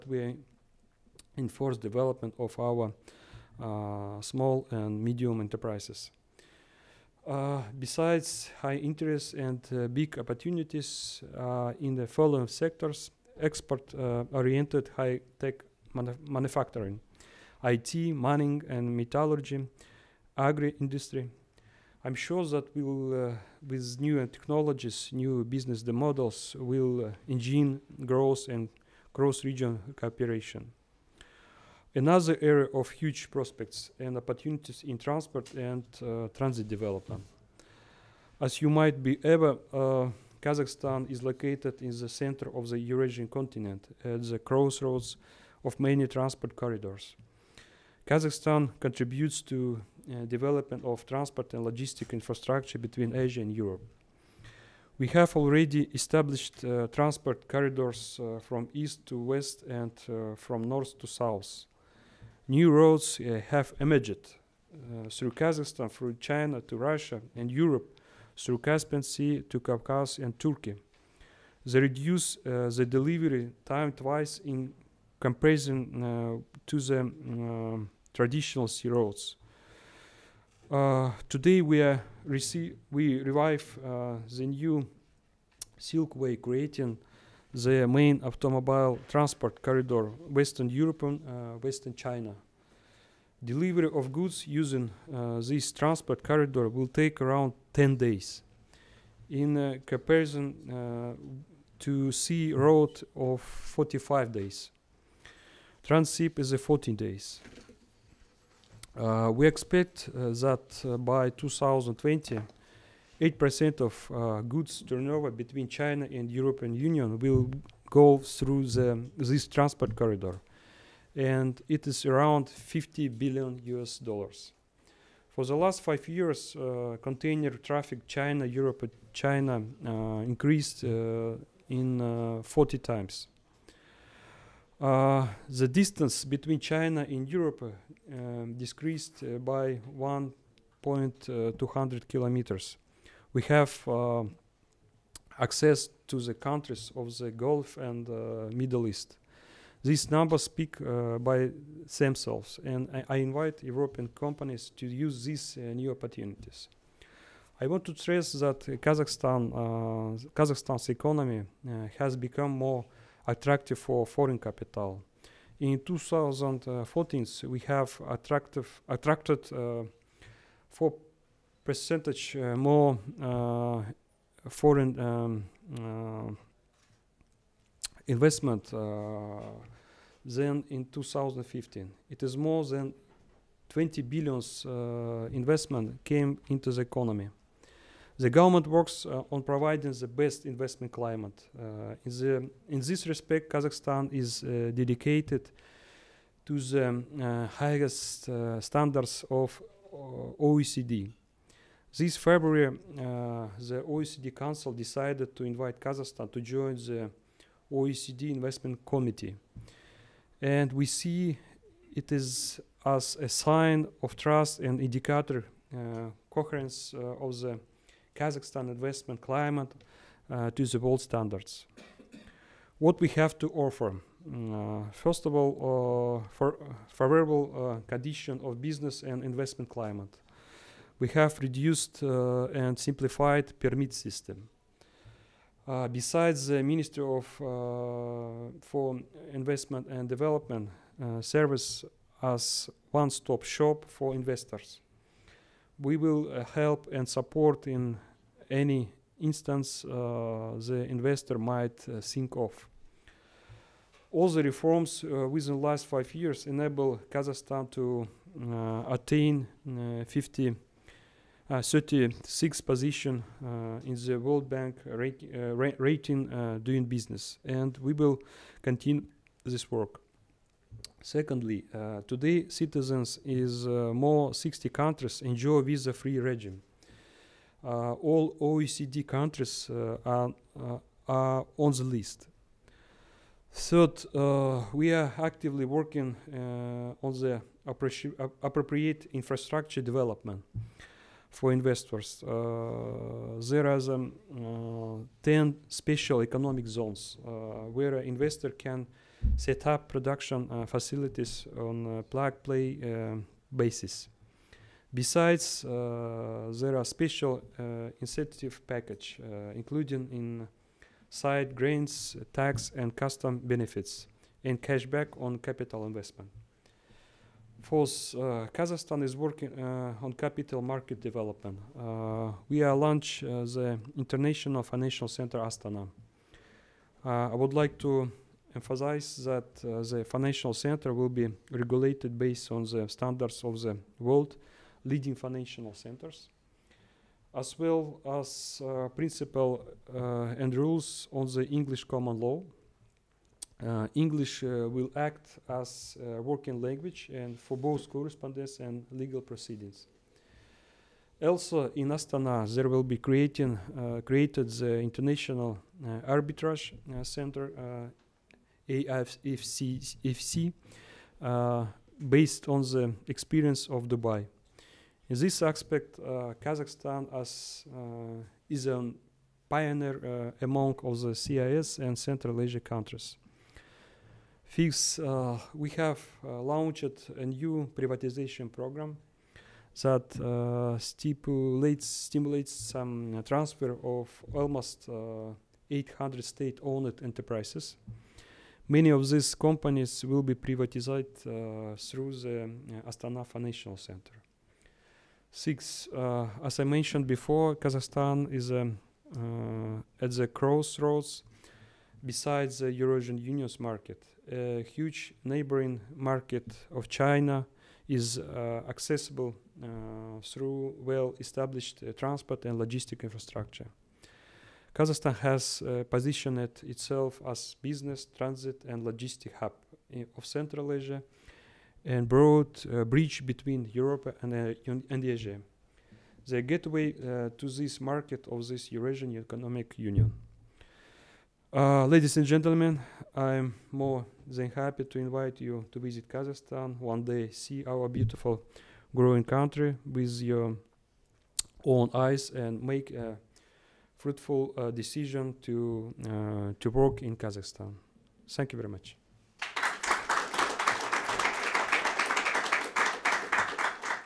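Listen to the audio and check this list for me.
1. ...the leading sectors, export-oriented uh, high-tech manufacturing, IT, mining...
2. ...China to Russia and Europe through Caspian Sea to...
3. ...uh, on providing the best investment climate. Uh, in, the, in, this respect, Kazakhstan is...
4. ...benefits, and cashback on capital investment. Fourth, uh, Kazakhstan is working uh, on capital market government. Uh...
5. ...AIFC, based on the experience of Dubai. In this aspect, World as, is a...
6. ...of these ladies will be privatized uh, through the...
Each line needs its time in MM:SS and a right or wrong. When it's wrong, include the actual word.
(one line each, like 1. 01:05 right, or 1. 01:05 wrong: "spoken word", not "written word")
1. 00:11 wrong: "following", not "leading"
2. 01:06 right
3. 03:09 right
4. 05:13 wrong: "development", not "government"
5. 05:58 wrong: "Kazakhstan", not "World"
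6. 06:28 wrong: "companies", not "ladies".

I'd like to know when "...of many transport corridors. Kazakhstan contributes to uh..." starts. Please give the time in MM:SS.
00:45.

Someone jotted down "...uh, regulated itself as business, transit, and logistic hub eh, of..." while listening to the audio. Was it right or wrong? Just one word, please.
wrong.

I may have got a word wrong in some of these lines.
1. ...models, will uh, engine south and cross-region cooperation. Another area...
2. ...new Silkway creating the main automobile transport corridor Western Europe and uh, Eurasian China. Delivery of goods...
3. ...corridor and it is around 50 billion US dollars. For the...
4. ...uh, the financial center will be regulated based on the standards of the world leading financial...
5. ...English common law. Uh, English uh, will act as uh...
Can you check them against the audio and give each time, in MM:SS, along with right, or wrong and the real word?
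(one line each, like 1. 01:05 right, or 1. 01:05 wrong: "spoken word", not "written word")
1. 00:25 wrong: "growth", not "south"
2. 01:24 wrong: "Western", not "Eurasian"
3. 01:59 right
4. 05:29 right
5. 05:41 right.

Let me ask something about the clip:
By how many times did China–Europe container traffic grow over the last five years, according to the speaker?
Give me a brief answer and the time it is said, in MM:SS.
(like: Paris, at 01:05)
40 times, at 02:12.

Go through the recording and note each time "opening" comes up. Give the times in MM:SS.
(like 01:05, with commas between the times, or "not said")
not said.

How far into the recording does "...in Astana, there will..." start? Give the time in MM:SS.
05:51.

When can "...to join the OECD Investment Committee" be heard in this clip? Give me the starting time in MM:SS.
03:26.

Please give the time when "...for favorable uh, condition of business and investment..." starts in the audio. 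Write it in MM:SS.
03:46.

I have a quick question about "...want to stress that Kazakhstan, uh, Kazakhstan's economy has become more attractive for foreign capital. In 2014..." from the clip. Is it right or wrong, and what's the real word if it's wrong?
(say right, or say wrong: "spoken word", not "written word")
right.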